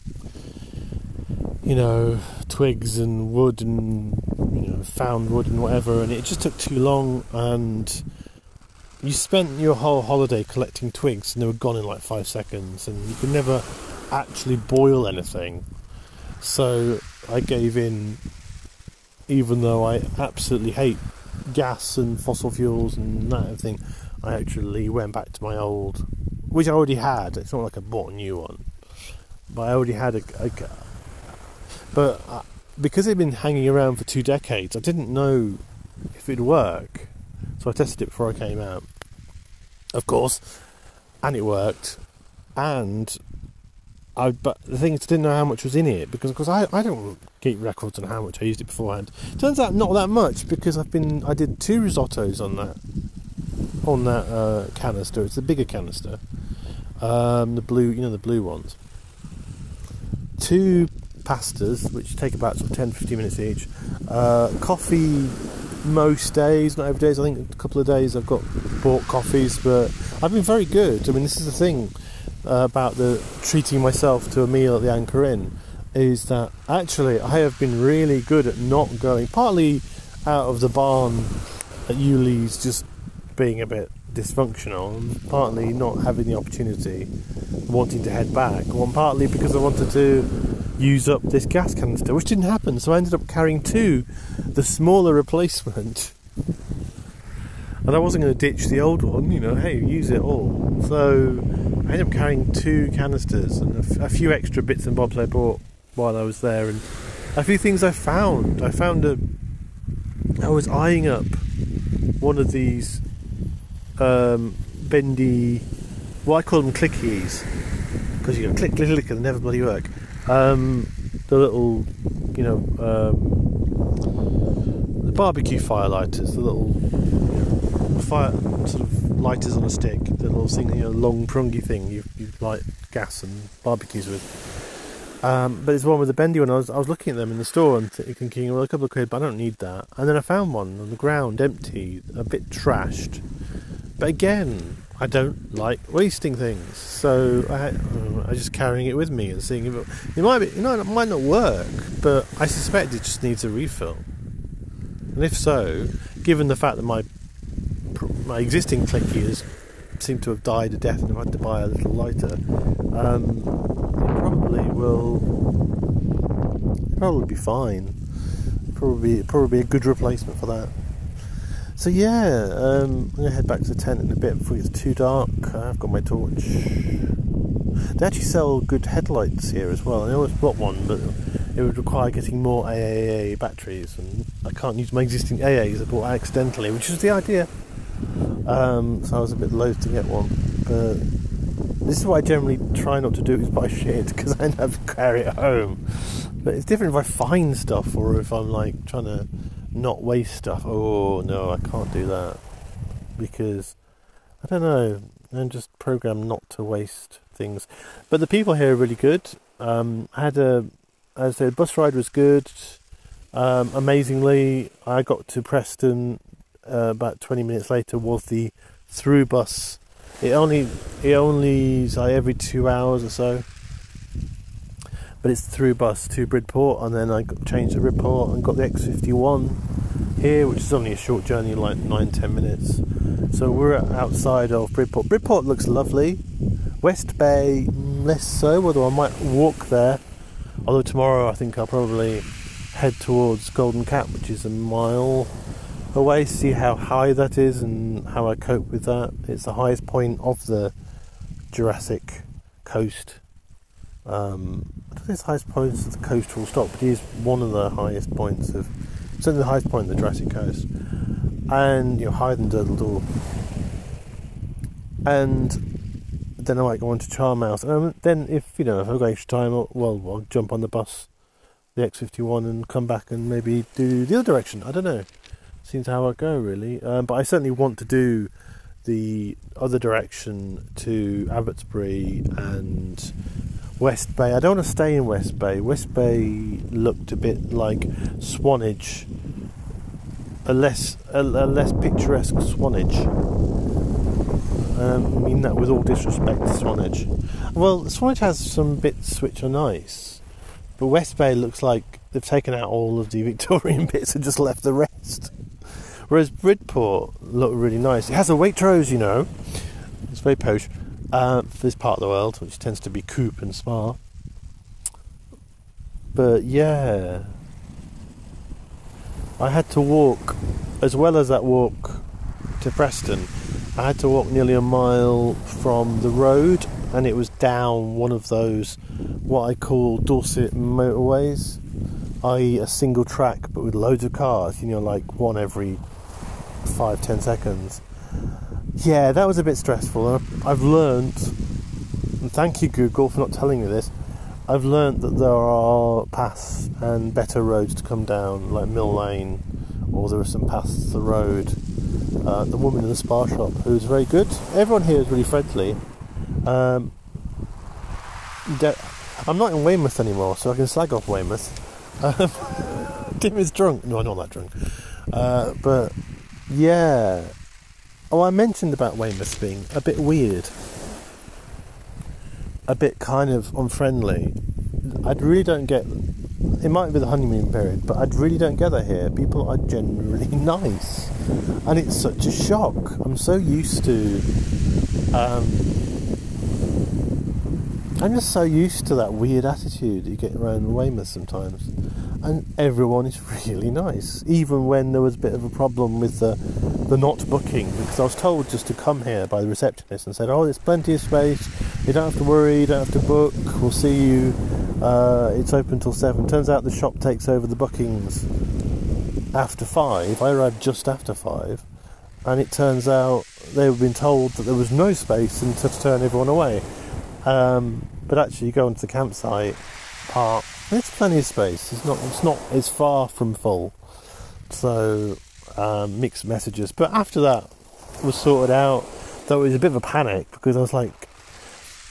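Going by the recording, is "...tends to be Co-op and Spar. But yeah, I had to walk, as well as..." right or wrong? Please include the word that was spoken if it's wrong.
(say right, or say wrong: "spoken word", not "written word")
right.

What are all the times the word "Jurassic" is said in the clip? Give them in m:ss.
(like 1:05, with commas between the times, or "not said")
4:11, 4:19.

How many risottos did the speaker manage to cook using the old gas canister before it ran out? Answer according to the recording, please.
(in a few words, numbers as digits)
2.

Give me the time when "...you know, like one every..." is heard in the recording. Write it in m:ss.
5:34.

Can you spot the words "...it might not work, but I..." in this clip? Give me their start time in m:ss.
2:30.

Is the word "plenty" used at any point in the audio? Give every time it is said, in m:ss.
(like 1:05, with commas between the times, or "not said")
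6:40, 7:00.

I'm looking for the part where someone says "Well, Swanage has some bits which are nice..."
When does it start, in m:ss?
4:57.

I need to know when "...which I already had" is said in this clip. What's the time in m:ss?
0:26.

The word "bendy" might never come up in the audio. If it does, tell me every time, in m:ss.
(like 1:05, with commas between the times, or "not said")
1:54, 2:16.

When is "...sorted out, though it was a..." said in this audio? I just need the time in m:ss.
7:08.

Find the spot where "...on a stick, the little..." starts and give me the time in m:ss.
2:09.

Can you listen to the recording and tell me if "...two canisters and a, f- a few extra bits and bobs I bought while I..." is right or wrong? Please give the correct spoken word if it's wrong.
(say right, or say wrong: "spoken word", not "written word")
right.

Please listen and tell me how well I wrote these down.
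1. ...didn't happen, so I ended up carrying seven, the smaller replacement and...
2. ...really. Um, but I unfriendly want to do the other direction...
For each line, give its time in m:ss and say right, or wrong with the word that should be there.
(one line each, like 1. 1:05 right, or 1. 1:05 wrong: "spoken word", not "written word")
1. 1:32 wrong: "two", not "seven"
2. 4:36 wrong: "certainly", not "unfriendly".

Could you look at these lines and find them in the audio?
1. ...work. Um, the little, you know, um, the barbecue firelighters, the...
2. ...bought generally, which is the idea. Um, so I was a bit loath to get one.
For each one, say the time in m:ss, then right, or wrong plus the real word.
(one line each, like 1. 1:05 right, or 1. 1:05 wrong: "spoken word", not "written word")
1. 1:59 right
2. 3:05 wrong: "accidentally", not "generally".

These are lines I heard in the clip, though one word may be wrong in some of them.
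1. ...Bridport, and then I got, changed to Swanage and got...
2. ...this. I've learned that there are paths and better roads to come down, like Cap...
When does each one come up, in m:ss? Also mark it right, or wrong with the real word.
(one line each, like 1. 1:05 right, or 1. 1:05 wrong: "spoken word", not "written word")
1. 3:46 wrong: "Bridport", not "Swanage"
2. 5:43 wrong: "Mill", not "Cap".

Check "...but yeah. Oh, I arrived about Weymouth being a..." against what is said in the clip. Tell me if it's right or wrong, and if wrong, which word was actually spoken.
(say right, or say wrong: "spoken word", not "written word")
wrong: "mentioned", not "arrived".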